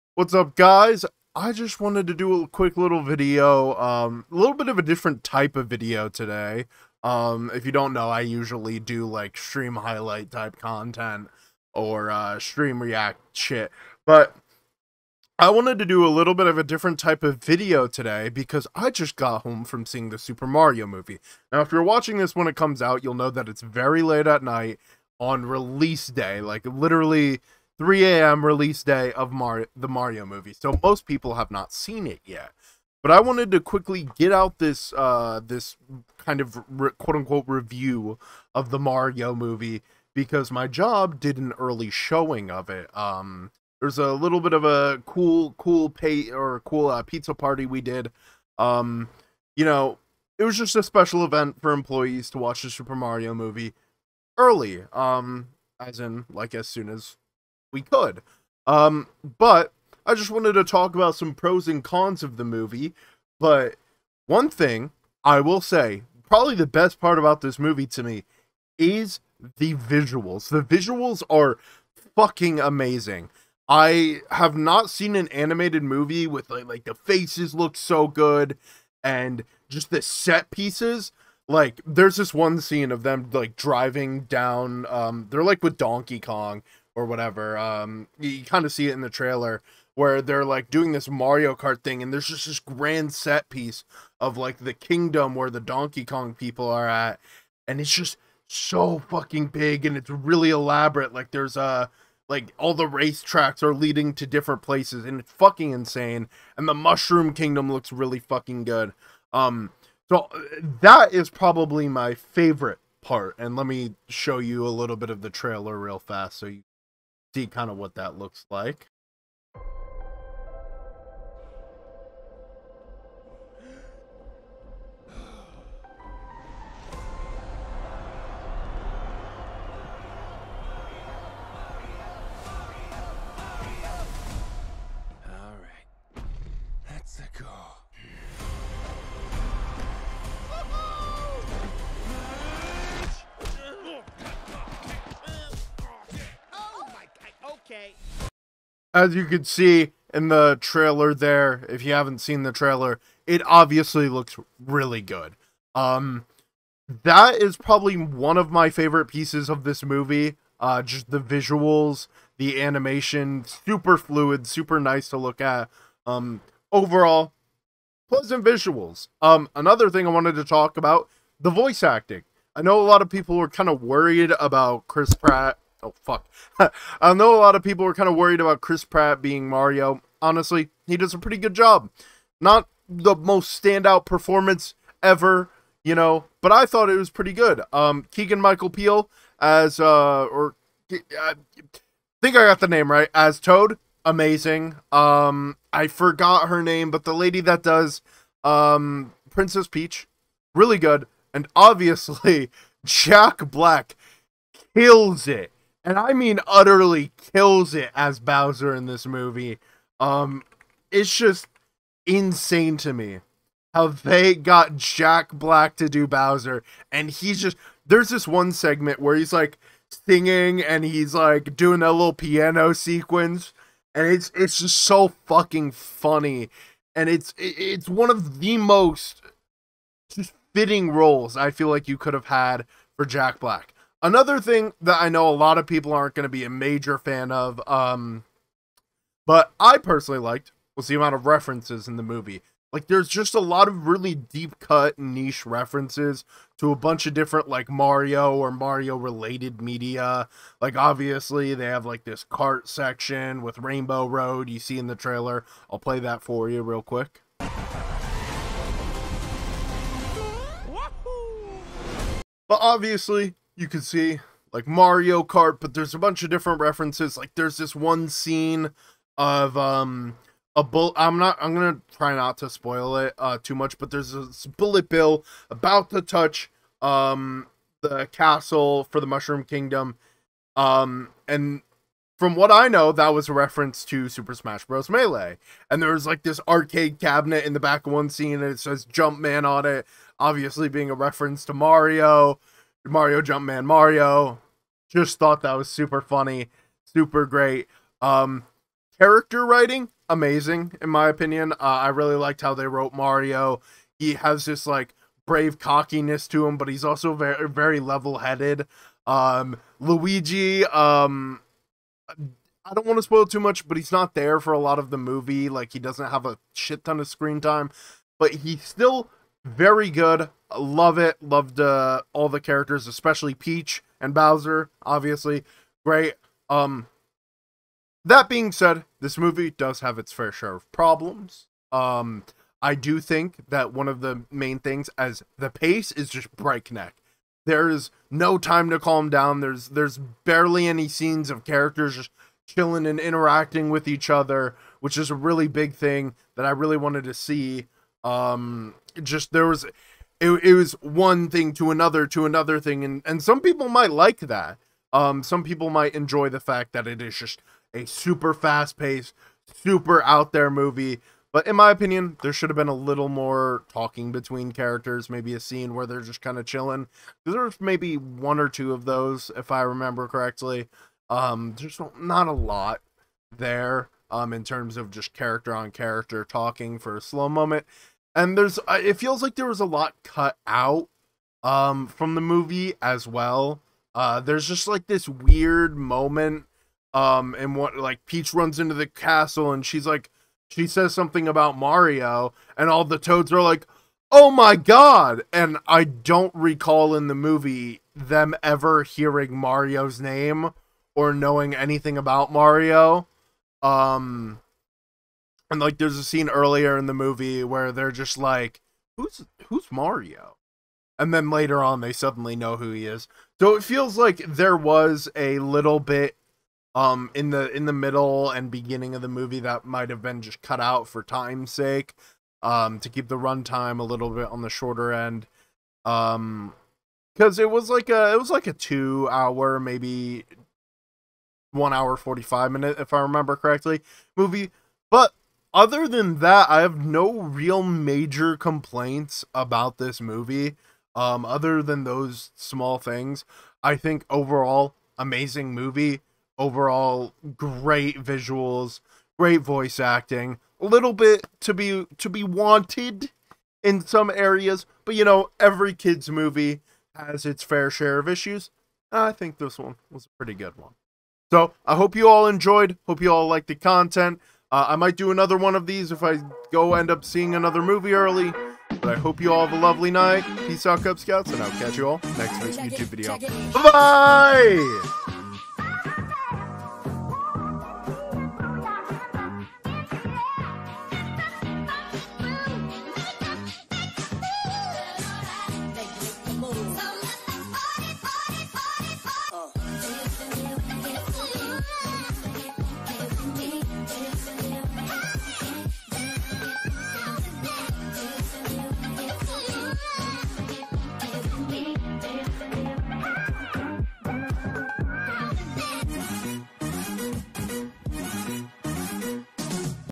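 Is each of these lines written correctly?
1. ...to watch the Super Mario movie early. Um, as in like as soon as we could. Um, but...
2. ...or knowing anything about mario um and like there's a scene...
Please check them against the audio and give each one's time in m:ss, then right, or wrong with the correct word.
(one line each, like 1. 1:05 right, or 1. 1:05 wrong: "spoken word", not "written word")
1. 0:52 right
2. 6:40 right.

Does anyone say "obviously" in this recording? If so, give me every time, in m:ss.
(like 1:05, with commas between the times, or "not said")
2:33, 3:21, 4:10, 4:22, 4:50, 5:24.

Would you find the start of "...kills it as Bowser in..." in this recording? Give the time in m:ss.
3:27.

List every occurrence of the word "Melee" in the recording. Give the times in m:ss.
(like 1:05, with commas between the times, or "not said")
4:44.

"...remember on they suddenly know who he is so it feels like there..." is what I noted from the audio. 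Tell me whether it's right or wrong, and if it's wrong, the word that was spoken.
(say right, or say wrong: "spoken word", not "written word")
wrong: "later", not "remember".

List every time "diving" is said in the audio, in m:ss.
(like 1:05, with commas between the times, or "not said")
not said.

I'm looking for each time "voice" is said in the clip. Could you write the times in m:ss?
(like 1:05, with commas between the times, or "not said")
2:51, 7:29.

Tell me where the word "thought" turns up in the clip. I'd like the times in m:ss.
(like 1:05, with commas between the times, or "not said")
3:06, 4:55.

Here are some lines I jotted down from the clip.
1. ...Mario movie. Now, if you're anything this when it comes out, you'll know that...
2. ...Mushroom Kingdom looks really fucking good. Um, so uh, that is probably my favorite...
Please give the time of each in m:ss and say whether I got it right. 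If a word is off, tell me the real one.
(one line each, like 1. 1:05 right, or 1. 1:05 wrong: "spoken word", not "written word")
1. 0:20 wrong: "watching", not "anything"
2. 1:46 right.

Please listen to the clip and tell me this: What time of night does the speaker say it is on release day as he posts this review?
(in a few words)
3 a.m.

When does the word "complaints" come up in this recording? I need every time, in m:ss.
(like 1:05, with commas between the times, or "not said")
7:18.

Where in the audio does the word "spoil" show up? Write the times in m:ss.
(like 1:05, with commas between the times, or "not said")
4:32, 5:13.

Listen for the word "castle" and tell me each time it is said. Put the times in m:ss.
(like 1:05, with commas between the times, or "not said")
4:38, 6:28.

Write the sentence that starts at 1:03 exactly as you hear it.
But one thing I will say, probably the best part about this movie to me is the visuals.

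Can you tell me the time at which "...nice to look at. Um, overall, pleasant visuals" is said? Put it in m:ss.
2:44.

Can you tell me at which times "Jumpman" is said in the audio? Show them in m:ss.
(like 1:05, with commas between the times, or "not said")
4:48, 4:53.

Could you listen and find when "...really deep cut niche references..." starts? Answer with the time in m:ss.
4:03.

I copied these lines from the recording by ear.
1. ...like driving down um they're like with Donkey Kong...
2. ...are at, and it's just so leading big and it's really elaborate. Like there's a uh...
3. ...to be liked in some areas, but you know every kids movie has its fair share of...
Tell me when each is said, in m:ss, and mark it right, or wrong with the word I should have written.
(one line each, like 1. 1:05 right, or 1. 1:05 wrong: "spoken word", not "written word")
1. 1:23 right
2. 1:36 wrong: "fucking", not "leading"
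3. 7:31 wrong: "wanted", not "liked".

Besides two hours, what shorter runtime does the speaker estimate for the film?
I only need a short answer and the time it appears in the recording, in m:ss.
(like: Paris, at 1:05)
1 hour 45 minutes, at 7:11.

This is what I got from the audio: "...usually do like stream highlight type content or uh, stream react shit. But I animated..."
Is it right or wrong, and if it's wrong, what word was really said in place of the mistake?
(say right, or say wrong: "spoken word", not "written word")
wrong: "wanted", not "animated".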